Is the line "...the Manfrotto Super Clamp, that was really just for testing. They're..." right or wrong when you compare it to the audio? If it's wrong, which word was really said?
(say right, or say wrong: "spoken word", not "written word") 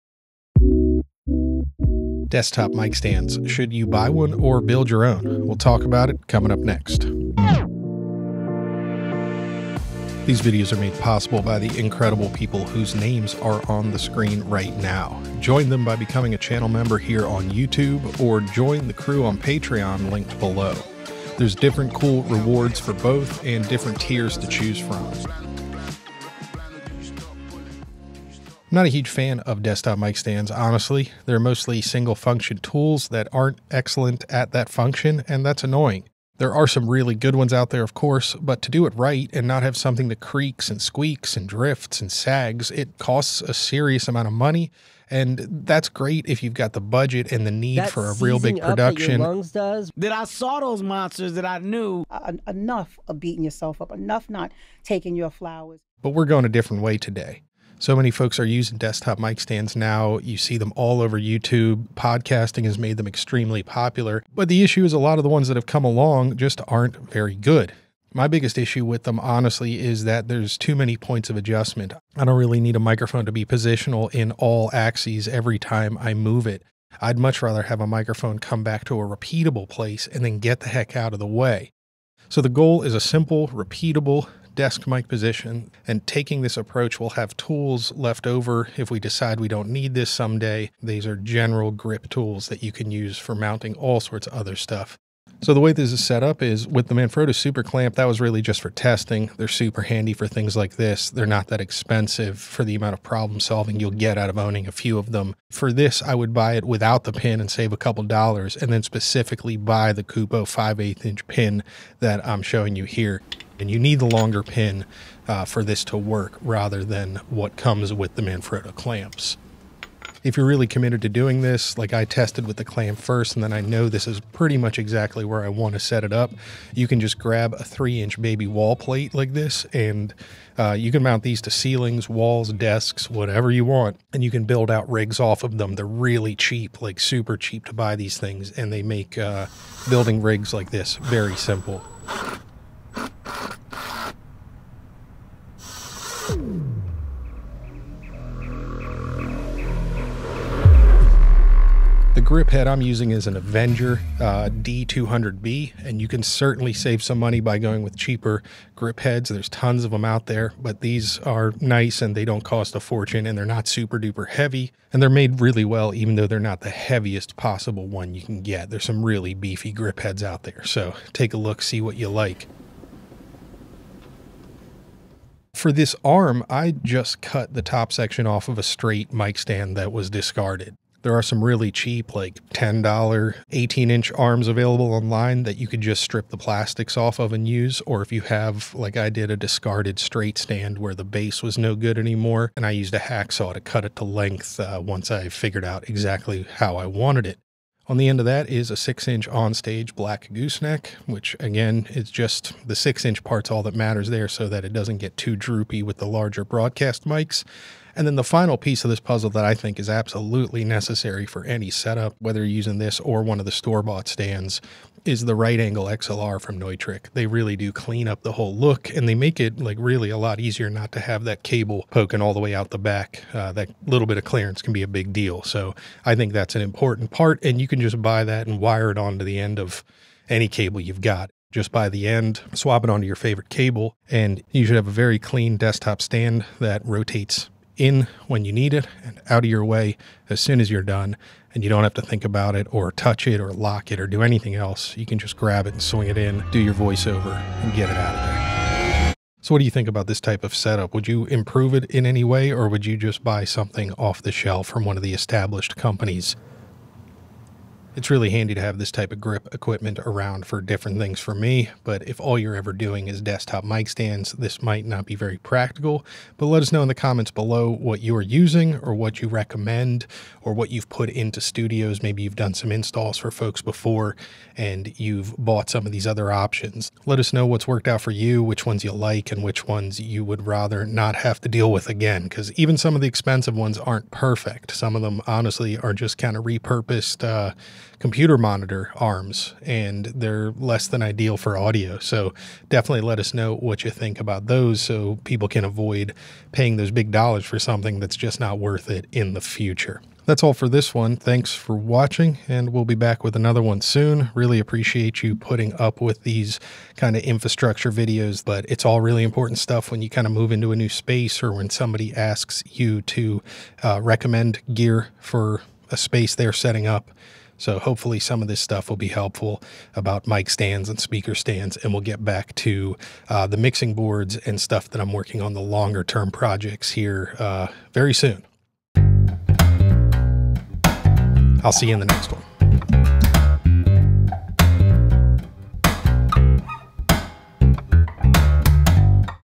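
right.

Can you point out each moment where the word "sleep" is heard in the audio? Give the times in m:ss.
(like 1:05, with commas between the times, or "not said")
not said.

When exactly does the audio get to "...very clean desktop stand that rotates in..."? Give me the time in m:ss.
3:54.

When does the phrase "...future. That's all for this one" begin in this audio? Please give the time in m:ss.
4:59.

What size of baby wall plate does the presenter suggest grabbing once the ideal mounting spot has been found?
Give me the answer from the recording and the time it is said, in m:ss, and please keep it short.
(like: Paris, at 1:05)
3 inch, at 2:07.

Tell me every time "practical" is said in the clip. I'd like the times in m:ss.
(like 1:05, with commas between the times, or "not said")
4:25.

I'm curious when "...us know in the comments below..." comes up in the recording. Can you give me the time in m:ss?
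4:26.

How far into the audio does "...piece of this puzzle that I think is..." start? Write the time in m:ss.
3:28.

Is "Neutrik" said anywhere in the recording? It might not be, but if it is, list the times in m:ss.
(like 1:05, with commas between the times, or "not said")
3:36.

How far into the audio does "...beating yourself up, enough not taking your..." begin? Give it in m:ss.
0:53.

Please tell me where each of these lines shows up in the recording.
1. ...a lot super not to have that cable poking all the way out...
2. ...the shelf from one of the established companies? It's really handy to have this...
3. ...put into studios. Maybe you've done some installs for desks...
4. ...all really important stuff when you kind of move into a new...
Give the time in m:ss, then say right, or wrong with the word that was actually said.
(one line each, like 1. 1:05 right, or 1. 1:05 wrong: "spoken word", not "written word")
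1. 3:40 wrong: "easier", not "super"
2. 4:14 right
3. 4:30 wrong: "folks", not "desks"
4. 5:08 right.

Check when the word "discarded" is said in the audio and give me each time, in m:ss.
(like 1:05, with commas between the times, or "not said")
3:00, 3:09.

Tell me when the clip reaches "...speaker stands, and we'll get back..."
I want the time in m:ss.
5:20.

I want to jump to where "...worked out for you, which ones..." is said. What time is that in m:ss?
4:37.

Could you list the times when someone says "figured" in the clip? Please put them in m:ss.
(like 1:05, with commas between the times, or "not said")
3:15.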